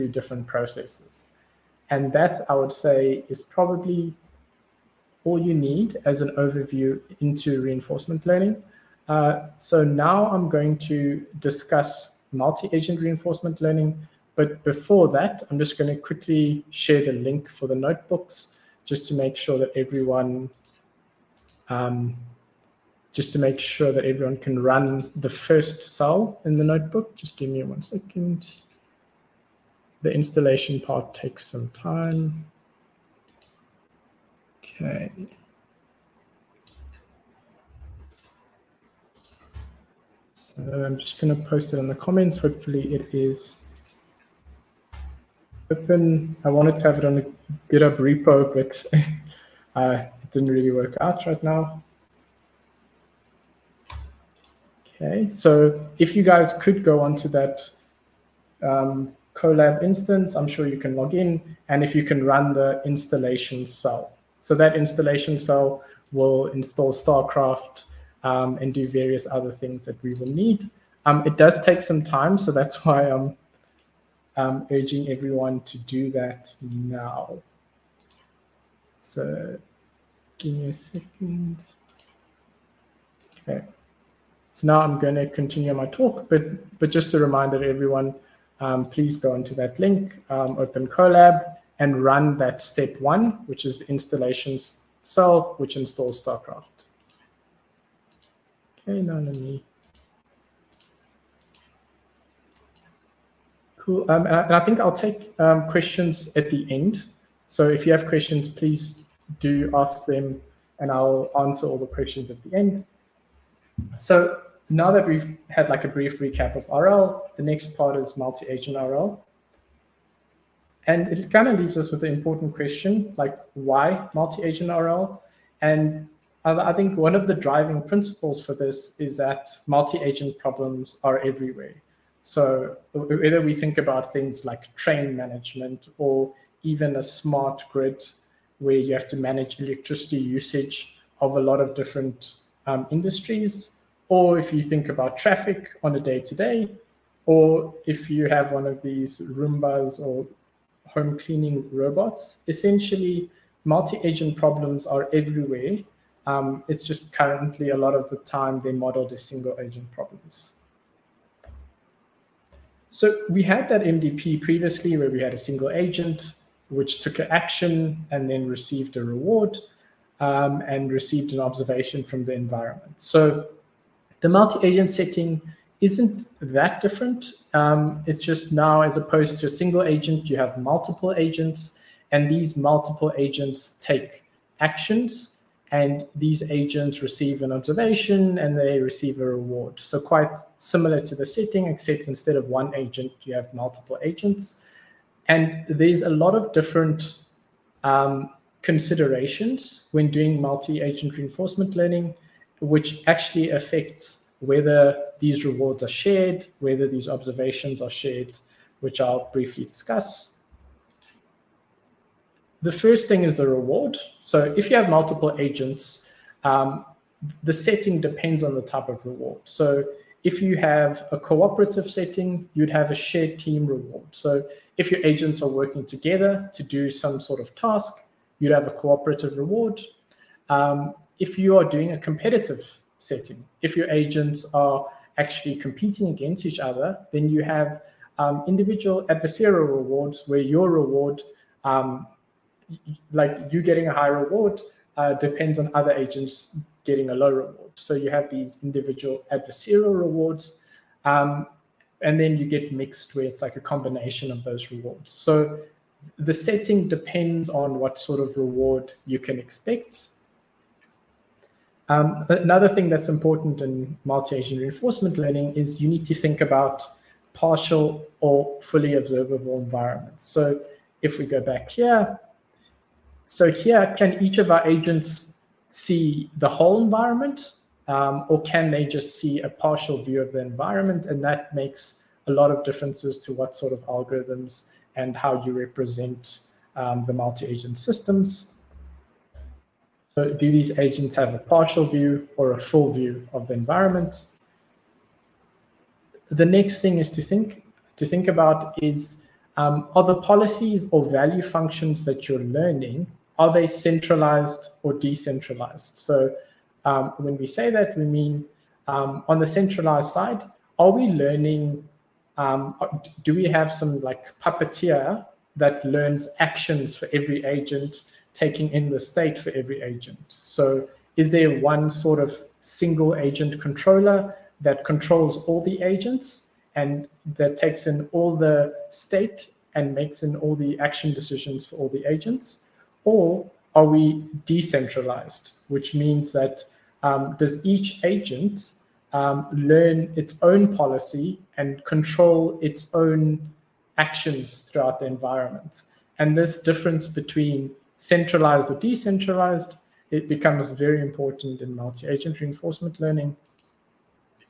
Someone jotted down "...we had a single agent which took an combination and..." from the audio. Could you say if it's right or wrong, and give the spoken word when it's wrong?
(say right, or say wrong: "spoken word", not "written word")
wrong: "action", not "combination".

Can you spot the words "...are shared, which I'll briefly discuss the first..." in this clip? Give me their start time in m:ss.
3:27.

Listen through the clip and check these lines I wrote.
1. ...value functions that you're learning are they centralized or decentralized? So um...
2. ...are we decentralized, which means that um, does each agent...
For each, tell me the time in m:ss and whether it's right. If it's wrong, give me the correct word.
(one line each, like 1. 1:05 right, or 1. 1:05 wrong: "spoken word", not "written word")
1. 5:01 right
2. 5:33 right.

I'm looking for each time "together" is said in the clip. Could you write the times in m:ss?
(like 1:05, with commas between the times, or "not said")
3:45.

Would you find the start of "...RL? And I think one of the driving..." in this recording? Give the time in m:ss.
2:04.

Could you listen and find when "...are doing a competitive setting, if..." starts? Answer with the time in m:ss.
3:51.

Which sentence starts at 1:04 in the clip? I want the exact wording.
So that installation cell will install StarCraft um, and do various other things that we will need.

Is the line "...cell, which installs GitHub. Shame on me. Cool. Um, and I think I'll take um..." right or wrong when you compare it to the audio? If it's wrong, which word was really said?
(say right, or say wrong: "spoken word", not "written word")
wrong: "StarCraft", not "GitHub".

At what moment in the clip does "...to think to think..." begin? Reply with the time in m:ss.
4:57.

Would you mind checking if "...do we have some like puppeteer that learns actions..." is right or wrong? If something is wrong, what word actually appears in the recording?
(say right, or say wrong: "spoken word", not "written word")
right.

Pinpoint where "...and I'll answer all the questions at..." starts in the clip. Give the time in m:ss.
1:50.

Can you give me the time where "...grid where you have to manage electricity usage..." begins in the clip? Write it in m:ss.
2:17.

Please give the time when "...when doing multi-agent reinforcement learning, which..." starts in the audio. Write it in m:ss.
3:19.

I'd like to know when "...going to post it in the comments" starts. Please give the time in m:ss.
0:41.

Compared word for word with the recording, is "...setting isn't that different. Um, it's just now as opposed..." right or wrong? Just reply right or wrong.
right.